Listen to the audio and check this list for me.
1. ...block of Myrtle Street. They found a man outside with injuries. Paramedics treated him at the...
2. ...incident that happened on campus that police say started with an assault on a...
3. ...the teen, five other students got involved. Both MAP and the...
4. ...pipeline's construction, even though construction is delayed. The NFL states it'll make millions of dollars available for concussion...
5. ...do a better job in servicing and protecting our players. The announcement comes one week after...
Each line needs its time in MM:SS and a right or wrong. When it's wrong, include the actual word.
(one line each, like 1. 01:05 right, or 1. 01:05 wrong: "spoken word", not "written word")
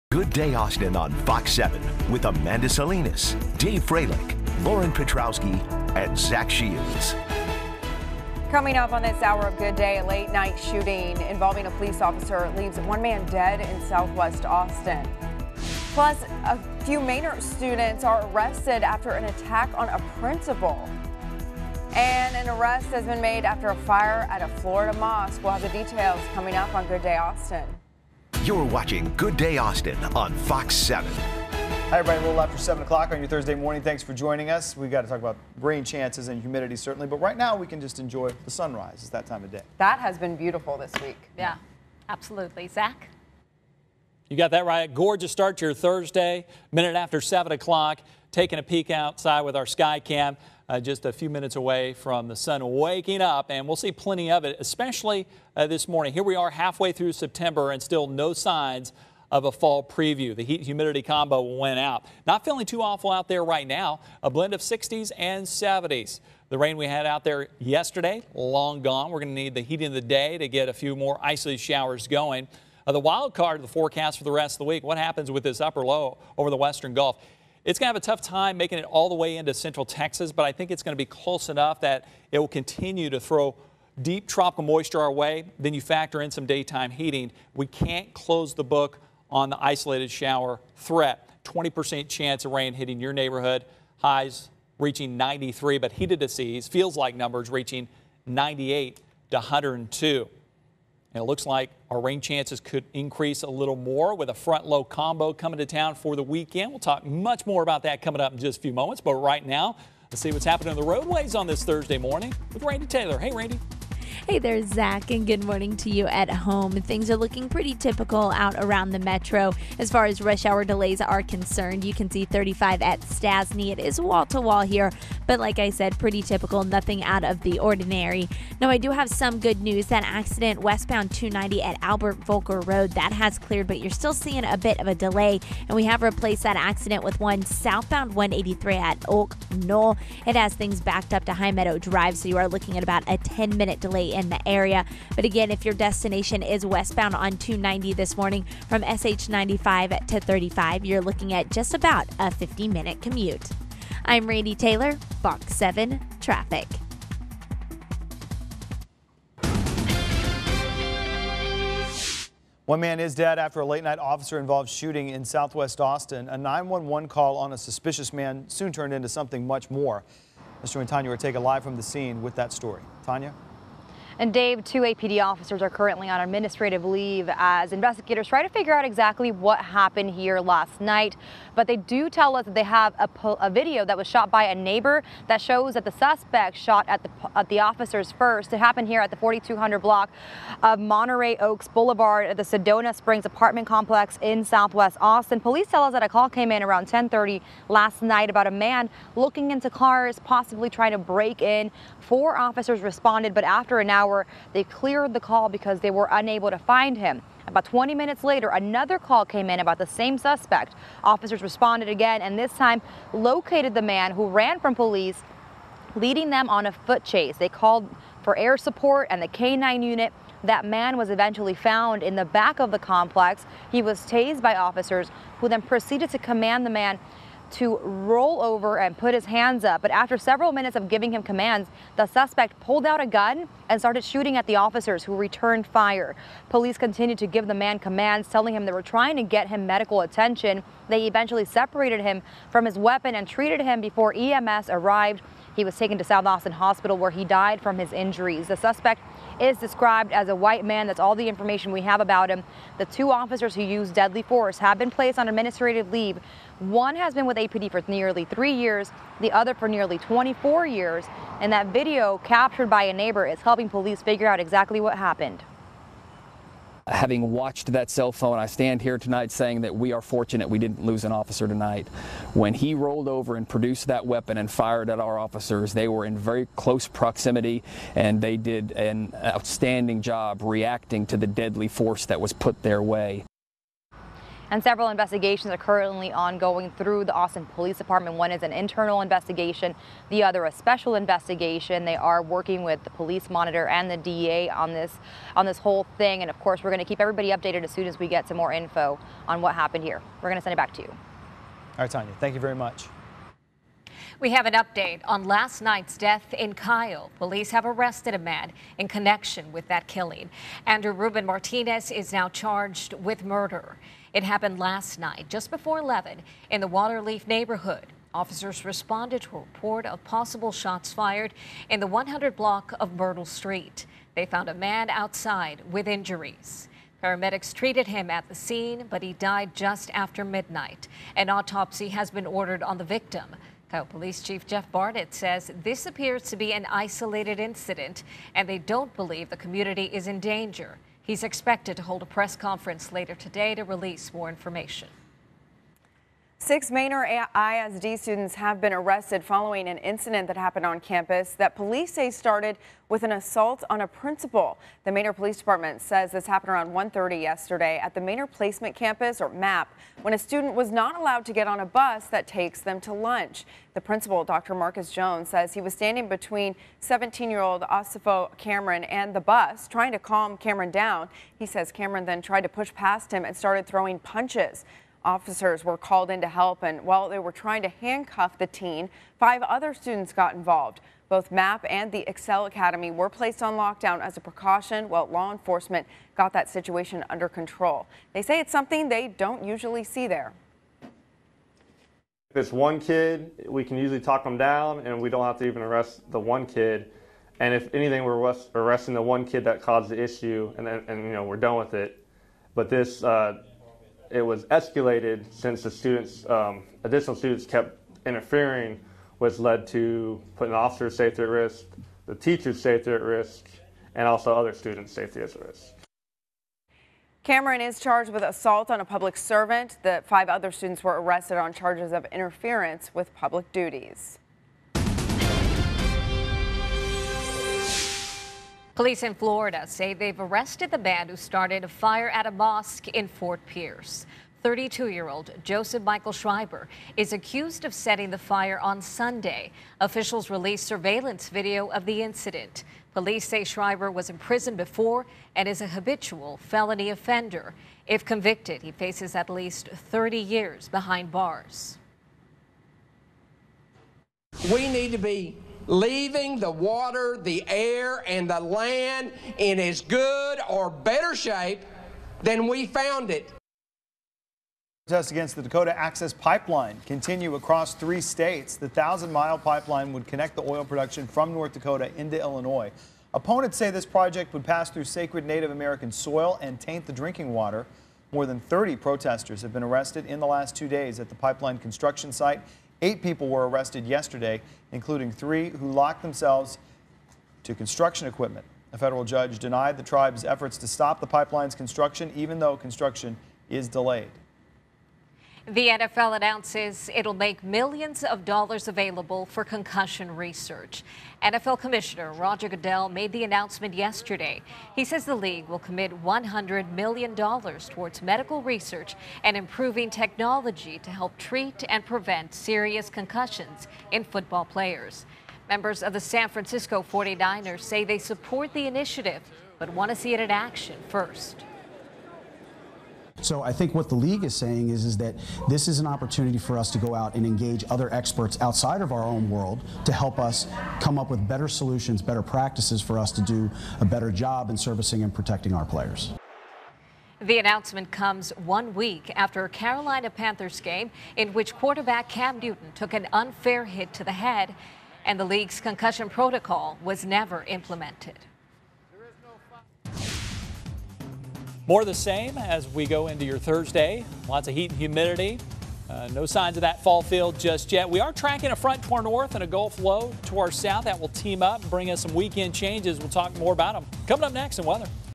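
1. 05:22 right
2. 05:49 right
3. 06:18 right
4. 08:11 wrong: "announces", not "states"
5. 08:53 right.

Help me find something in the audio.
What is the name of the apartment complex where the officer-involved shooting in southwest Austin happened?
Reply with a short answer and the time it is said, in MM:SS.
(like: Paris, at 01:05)
Sedona Springs, at 03:12.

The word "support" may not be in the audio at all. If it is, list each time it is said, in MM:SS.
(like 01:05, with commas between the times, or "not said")
03:38, 08:37.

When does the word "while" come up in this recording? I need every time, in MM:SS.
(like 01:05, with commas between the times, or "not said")
06:16, 06:24.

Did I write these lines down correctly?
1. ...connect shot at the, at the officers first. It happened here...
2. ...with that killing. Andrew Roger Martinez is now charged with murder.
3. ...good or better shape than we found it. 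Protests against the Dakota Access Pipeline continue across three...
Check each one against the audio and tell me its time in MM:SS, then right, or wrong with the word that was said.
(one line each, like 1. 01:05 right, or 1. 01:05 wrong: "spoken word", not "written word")
1. 03:05 wrong: "suspect", not "connect"
2. 05:09 wrong: "Ruben", not "Roger"
3. 07:39 right.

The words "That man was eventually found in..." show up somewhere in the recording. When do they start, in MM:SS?
03:40.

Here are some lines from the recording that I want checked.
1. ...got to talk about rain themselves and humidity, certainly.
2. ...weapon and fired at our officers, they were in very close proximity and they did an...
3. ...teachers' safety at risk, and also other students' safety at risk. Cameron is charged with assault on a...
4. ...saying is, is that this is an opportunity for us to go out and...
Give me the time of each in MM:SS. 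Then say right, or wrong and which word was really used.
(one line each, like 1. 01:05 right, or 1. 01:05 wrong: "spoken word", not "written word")
1. 00:34 wrong: "chances", not "themselves"
2. 04:34 right
3. 06:52 right
4. 08:44 right.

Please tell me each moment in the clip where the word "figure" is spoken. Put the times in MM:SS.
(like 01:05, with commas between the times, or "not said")
02:58, 04:24.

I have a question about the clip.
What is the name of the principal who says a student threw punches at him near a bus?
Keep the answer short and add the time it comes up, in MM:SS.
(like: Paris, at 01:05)
Dr. Marcus Jones, at 06:04.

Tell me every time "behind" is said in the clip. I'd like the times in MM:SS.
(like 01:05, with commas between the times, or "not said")
07:30.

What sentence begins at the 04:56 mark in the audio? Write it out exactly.
And of course, we're going to keep everybody updated as soon as we get some more info on what happened here.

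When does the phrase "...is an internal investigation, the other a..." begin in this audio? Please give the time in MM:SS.
04:48.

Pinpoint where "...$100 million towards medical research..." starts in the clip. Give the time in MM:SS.
08:26.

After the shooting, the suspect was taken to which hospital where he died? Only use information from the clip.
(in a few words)
South Austin Hospital.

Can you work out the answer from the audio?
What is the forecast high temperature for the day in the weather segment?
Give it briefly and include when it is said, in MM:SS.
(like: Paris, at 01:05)
93, at 01:35.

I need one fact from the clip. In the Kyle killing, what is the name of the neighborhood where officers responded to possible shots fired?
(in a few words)
Waterleaf.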